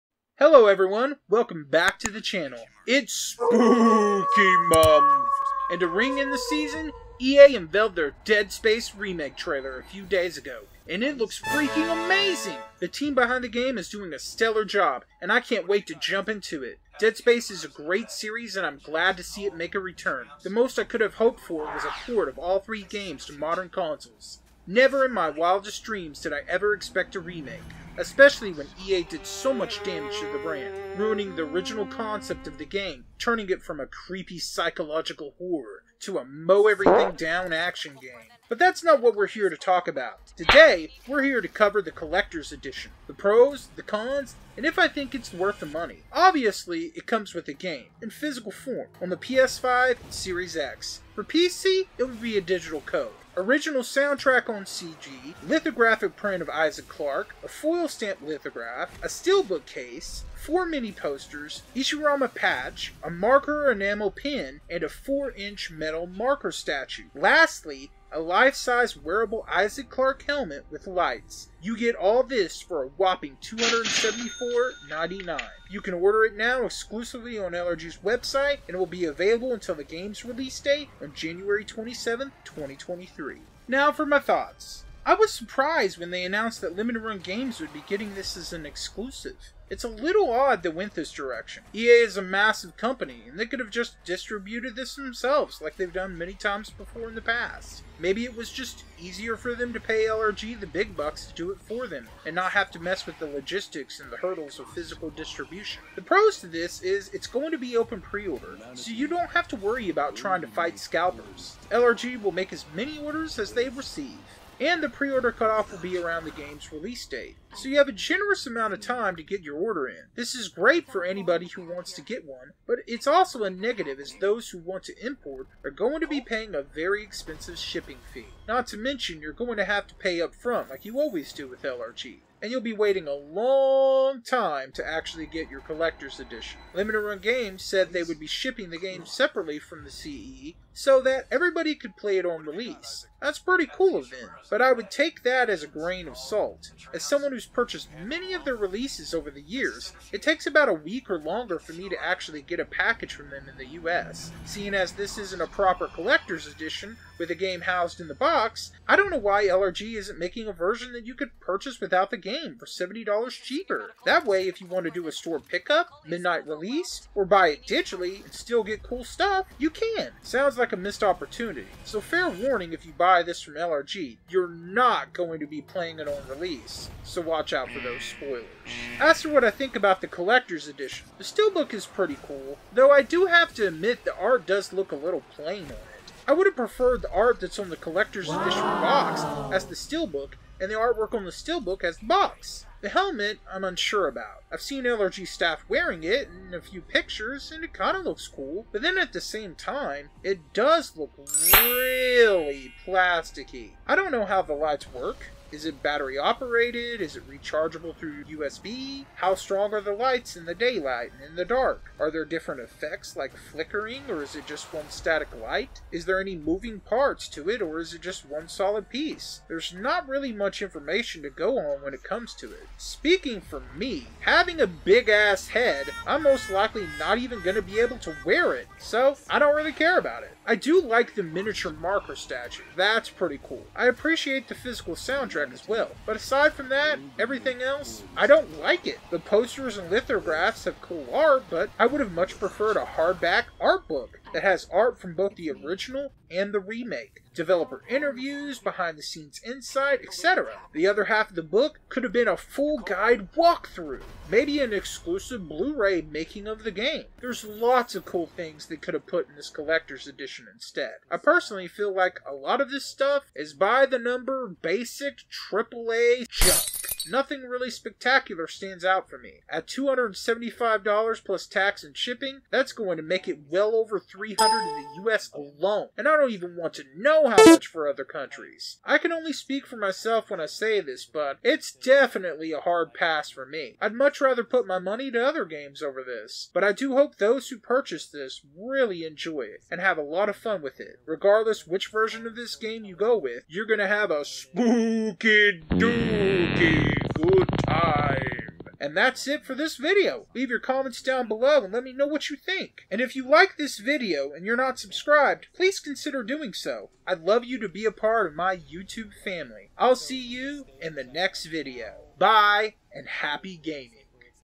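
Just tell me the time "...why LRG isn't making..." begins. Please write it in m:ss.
2:39.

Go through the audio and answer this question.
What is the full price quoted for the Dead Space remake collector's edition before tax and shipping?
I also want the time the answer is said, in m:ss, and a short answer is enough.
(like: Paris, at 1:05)
$274.99, at 1:13.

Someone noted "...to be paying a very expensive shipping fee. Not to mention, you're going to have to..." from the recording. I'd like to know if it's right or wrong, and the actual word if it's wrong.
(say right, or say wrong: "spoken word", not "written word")
right.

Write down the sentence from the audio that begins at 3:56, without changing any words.
But aside from that, everything else, I don't like it.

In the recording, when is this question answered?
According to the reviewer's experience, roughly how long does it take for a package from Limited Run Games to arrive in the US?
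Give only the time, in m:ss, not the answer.
2:30.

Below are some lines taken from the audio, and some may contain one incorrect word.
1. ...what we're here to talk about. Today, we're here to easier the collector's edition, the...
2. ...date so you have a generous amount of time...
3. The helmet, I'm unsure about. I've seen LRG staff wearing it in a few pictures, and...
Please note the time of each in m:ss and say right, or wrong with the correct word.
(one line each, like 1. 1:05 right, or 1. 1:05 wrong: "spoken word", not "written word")
1. 0:39 wrong: "cover", not "easier"
2. 1:57 right
3. 3:12 right.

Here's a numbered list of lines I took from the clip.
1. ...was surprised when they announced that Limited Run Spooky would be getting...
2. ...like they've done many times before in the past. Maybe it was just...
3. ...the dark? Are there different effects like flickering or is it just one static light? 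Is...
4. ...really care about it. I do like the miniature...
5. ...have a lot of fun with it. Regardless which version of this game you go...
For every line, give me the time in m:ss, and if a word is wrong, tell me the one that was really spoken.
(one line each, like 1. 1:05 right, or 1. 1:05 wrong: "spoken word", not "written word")
1. 1:25 wrong: "Games", not "Spooky"
2. 1:35 right
3. 3:31 right
4. 3:49 right
5. 4:49 right.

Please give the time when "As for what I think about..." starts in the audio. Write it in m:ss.
2:58.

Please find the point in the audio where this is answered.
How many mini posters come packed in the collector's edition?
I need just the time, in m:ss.
1:00.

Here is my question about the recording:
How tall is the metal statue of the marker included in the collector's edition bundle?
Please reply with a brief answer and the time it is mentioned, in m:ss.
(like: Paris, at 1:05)
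4 inch, at 1:04.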